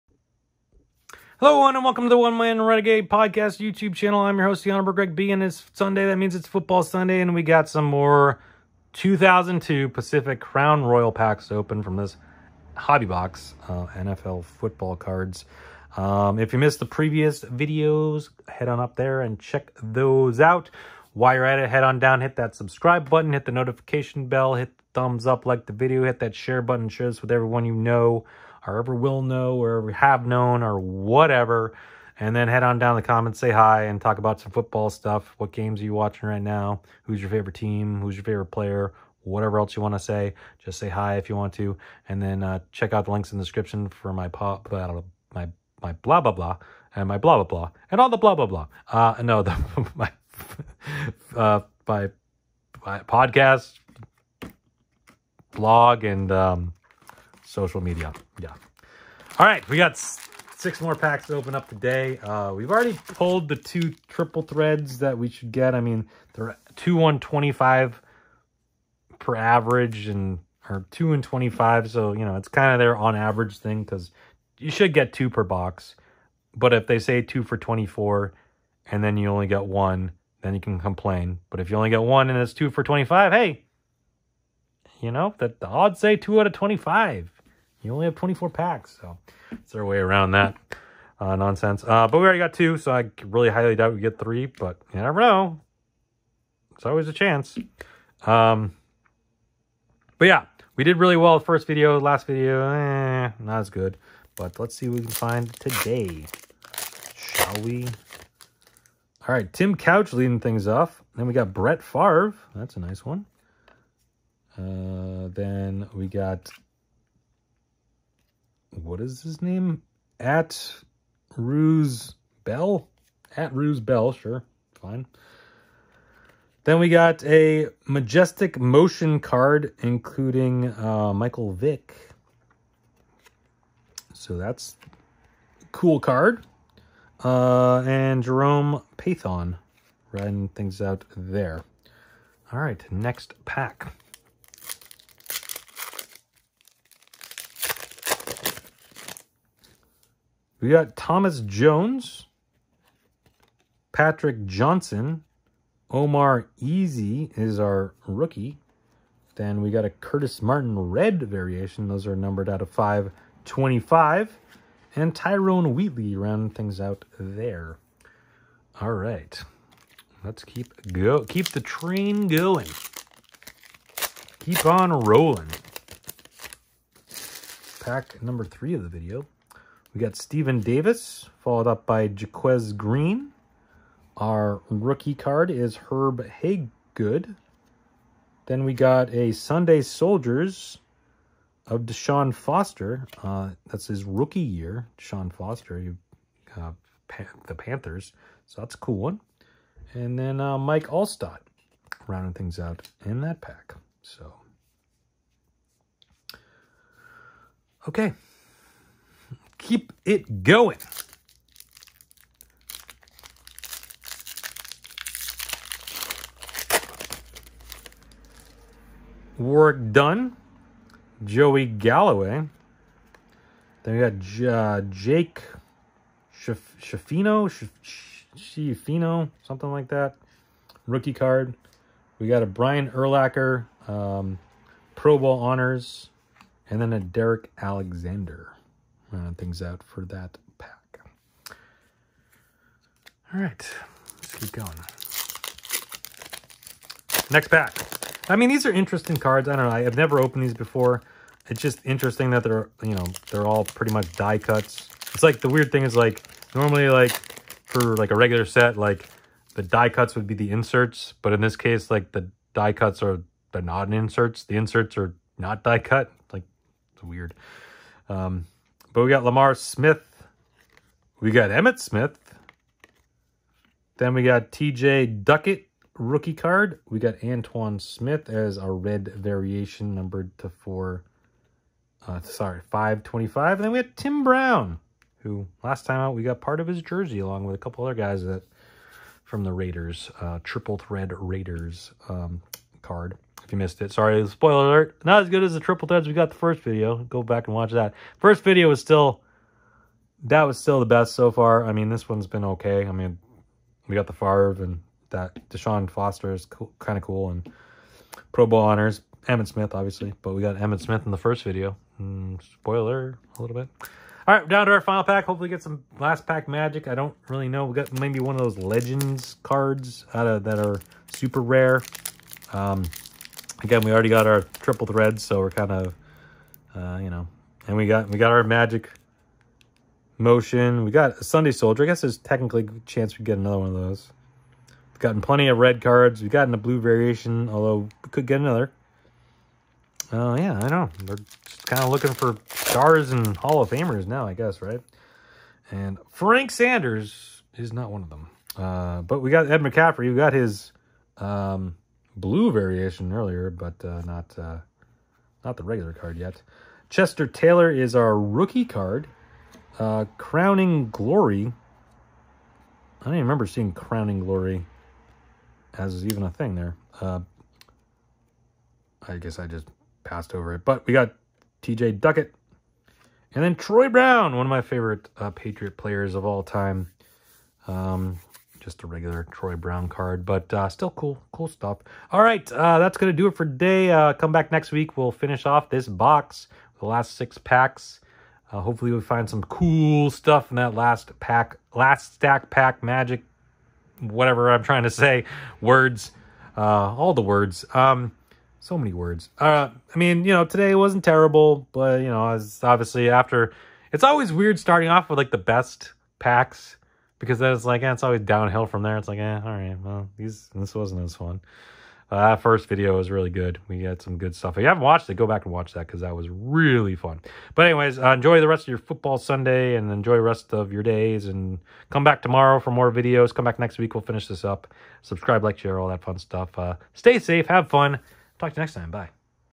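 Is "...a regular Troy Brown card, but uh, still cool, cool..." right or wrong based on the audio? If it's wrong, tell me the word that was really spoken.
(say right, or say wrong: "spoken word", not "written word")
right.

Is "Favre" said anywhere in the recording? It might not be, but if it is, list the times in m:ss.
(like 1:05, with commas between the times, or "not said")
1:51, 5:04.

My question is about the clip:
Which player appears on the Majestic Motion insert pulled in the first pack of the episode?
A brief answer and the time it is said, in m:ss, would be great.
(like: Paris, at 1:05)
Michael Vick, at 2:11.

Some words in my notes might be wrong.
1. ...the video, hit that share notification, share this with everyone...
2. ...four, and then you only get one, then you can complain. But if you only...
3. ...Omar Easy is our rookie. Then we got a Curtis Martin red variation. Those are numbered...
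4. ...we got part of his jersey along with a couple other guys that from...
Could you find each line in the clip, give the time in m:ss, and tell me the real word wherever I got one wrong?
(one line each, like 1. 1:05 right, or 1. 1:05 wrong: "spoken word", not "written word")
1. 0:25 wrong: "button", not "notification"
2. 1:17 right
3. 2:35 right
4. 4:46 right.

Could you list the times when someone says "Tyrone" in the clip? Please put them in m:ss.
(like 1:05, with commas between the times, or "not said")
2:45.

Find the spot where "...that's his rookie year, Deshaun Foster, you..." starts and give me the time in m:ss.
3:13.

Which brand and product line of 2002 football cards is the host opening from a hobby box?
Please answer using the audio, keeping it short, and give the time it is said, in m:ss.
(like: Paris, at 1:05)
Pacific Crown Royale, at 0:09.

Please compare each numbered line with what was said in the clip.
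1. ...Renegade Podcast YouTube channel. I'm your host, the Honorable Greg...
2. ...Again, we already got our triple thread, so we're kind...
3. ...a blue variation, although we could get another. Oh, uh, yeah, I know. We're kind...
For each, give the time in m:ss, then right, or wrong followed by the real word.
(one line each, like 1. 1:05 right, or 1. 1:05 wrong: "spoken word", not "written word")
1. 0:02 right
2. 5:23 right
3. 5:36 right.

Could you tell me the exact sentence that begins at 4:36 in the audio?
We got Antowain Smith as a red variation numbered to 4.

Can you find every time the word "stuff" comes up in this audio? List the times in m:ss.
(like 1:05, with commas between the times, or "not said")
0:34, 6:21, 6:30, 6:54, 7:06.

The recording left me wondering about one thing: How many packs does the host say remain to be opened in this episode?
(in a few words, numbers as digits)
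6.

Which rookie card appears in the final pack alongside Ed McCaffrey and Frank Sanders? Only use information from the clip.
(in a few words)
Chester Taylor.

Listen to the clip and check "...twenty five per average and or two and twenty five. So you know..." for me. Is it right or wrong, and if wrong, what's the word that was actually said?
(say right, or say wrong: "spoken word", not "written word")
right.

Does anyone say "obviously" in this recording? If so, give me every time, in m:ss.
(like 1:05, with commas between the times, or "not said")
5:09, 6:42.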